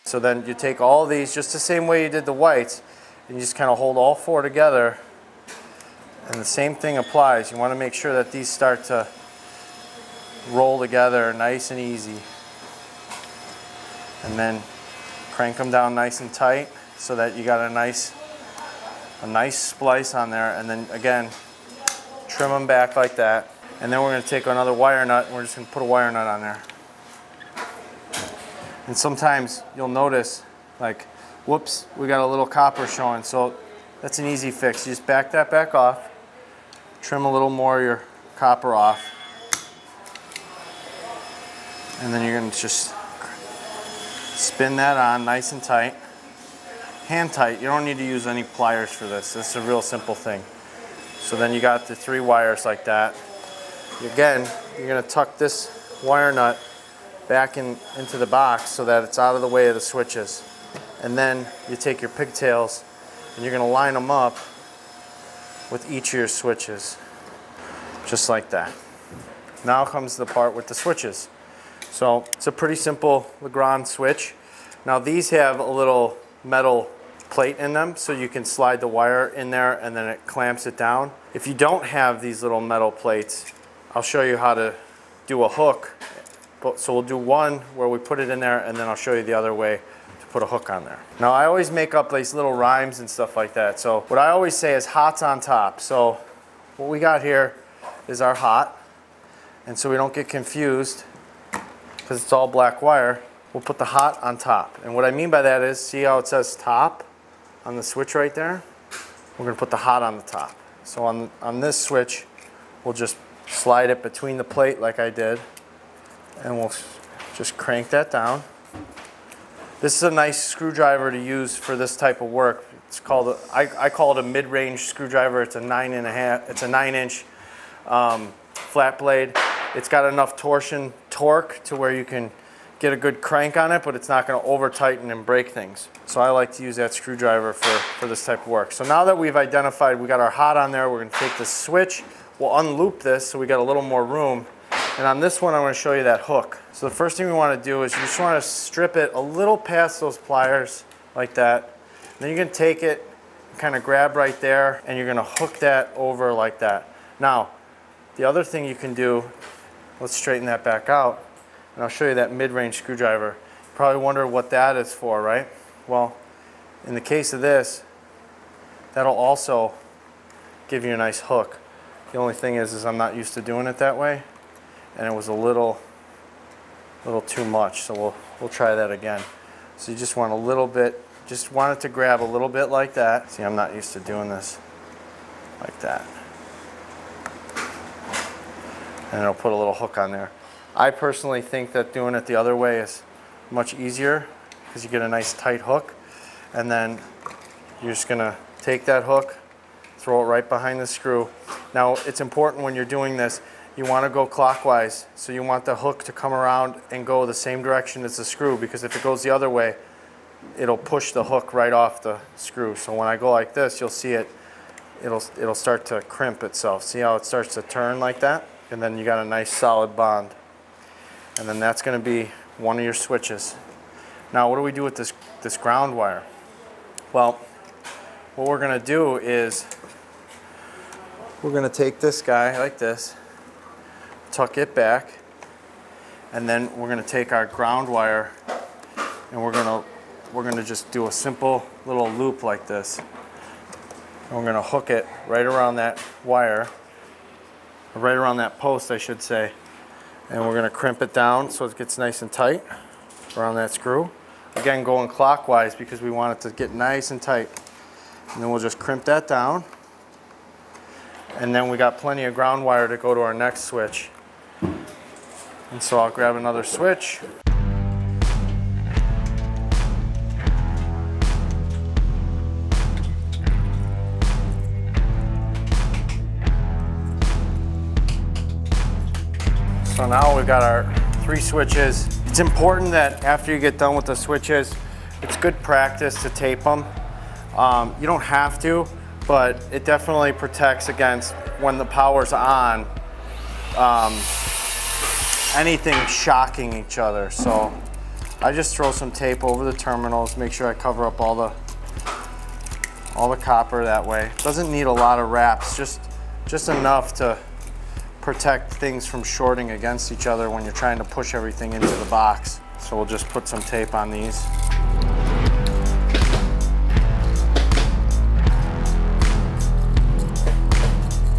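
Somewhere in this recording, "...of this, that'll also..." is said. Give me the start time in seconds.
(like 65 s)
167 s.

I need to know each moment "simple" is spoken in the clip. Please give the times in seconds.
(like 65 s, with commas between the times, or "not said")
49 s, 72 s, 241 s.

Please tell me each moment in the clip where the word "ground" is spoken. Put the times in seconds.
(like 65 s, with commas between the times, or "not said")
225 s, 237 s, 262 s.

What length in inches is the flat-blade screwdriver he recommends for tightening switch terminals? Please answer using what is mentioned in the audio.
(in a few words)
9.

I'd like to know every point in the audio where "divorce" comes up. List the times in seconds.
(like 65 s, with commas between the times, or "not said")
not said.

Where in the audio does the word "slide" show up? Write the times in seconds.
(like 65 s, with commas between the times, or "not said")
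78 s, 113 s.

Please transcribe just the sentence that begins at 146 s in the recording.
So the first thing we wanna do is you just wanna strip it a little past those pliers like that.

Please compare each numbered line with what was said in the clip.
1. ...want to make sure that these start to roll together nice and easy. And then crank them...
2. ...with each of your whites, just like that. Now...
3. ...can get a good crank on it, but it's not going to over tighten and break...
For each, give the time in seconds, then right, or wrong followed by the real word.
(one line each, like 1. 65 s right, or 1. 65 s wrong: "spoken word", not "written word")
1. 7 s right
2. 65 s wrong: "switches", not "whites"
3. 132 s right.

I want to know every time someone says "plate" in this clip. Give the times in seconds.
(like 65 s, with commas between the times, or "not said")
77 s, 82 s, 114 s.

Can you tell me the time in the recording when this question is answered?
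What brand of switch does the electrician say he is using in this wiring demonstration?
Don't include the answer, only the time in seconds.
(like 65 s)
73 s.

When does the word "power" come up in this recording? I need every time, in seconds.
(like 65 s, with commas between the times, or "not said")
291 s.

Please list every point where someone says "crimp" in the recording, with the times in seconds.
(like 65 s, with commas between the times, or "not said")
216 s, 250 s, 258 s.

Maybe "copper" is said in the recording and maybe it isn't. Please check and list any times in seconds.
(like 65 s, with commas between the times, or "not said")
32 s, 38 s, 303 s.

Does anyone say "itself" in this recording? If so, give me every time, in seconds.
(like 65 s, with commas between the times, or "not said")
216 s.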